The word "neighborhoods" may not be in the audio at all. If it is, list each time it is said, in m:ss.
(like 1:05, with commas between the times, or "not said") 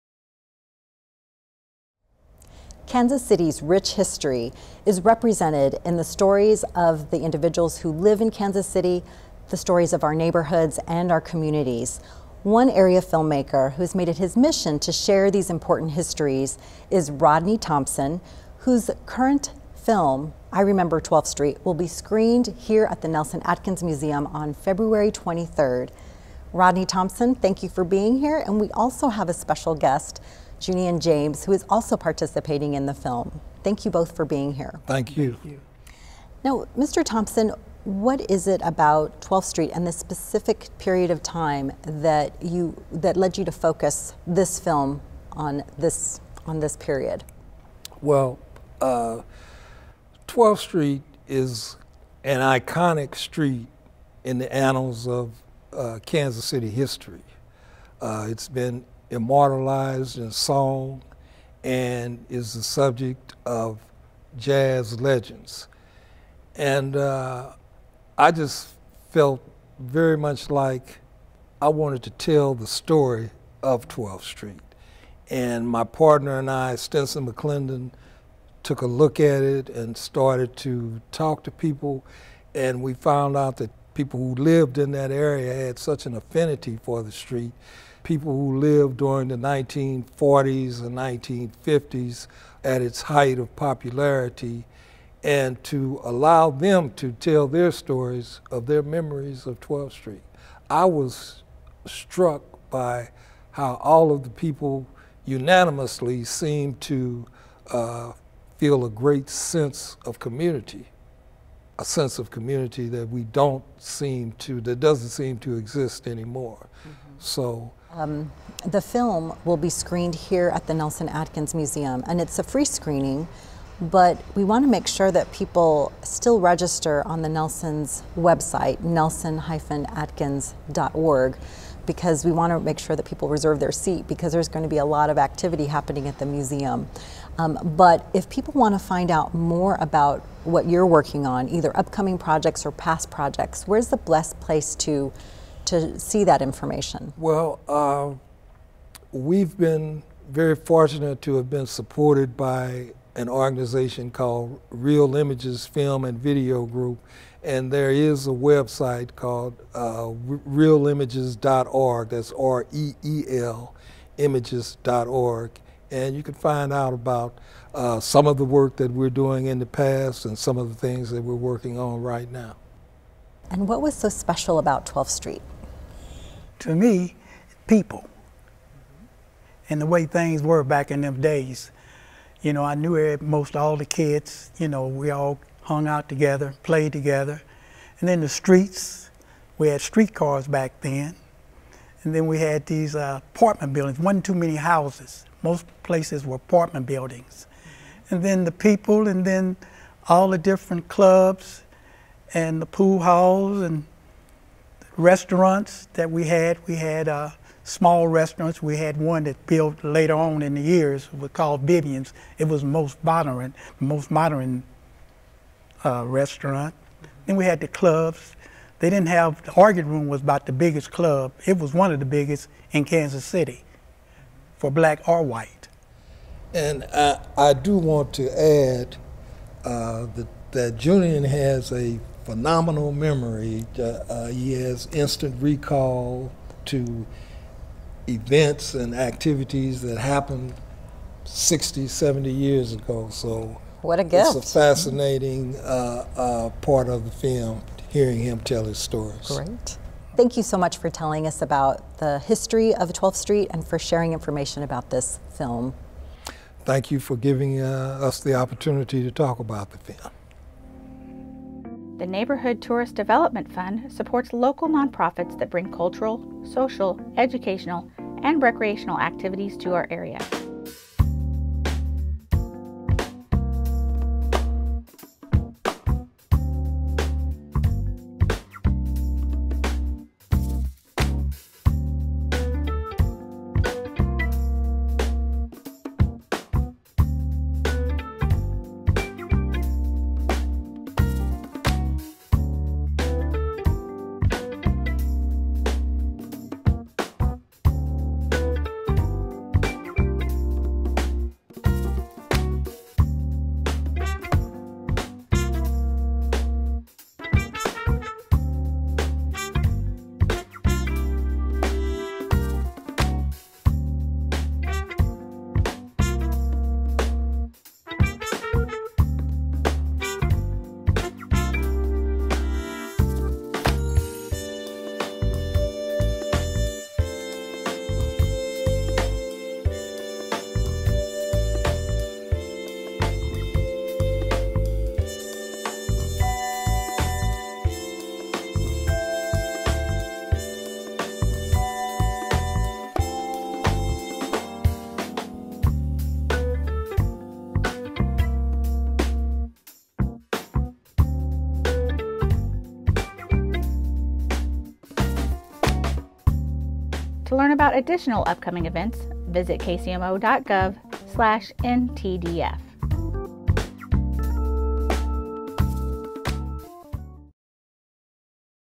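0:10, 4:22.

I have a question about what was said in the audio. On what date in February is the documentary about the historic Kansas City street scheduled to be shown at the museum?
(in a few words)
February 23.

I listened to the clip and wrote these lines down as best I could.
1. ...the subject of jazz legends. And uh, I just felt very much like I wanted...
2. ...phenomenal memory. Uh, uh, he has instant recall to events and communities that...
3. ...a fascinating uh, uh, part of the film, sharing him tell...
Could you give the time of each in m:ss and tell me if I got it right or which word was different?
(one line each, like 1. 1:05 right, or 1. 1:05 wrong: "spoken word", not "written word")
1. 1:02 right
2. 3:52 wrong: "activities", not "communities"
3. 4:04 wrong: "hearing", not "sharing".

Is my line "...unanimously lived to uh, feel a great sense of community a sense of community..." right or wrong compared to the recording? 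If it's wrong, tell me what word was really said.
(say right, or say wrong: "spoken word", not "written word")
wrong: "seemed", not "lived".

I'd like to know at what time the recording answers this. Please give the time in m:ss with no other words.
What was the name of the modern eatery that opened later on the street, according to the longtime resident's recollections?
3:31.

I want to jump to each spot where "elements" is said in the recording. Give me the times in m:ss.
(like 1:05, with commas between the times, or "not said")
not said.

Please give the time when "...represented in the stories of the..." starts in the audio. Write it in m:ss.
0:04.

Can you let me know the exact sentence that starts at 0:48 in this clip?
Well, uh, 12th Street is an iconic street in the annals of uh, Kansas City history.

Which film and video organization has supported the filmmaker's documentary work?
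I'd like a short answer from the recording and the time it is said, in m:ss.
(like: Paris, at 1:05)
Reel Images Film and Video Group, at 2:34.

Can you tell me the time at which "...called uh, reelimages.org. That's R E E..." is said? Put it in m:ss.
2:39.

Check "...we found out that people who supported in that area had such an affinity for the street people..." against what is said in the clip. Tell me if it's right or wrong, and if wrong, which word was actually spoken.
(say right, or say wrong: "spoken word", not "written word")
wrong: "lived", not "supported".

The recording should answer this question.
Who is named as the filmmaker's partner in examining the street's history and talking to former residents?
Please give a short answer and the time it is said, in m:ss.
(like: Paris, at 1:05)
Stenson McClendon, at 1:16.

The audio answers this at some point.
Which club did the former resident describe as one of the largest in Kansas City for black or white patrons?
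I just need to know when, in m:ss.
3:39.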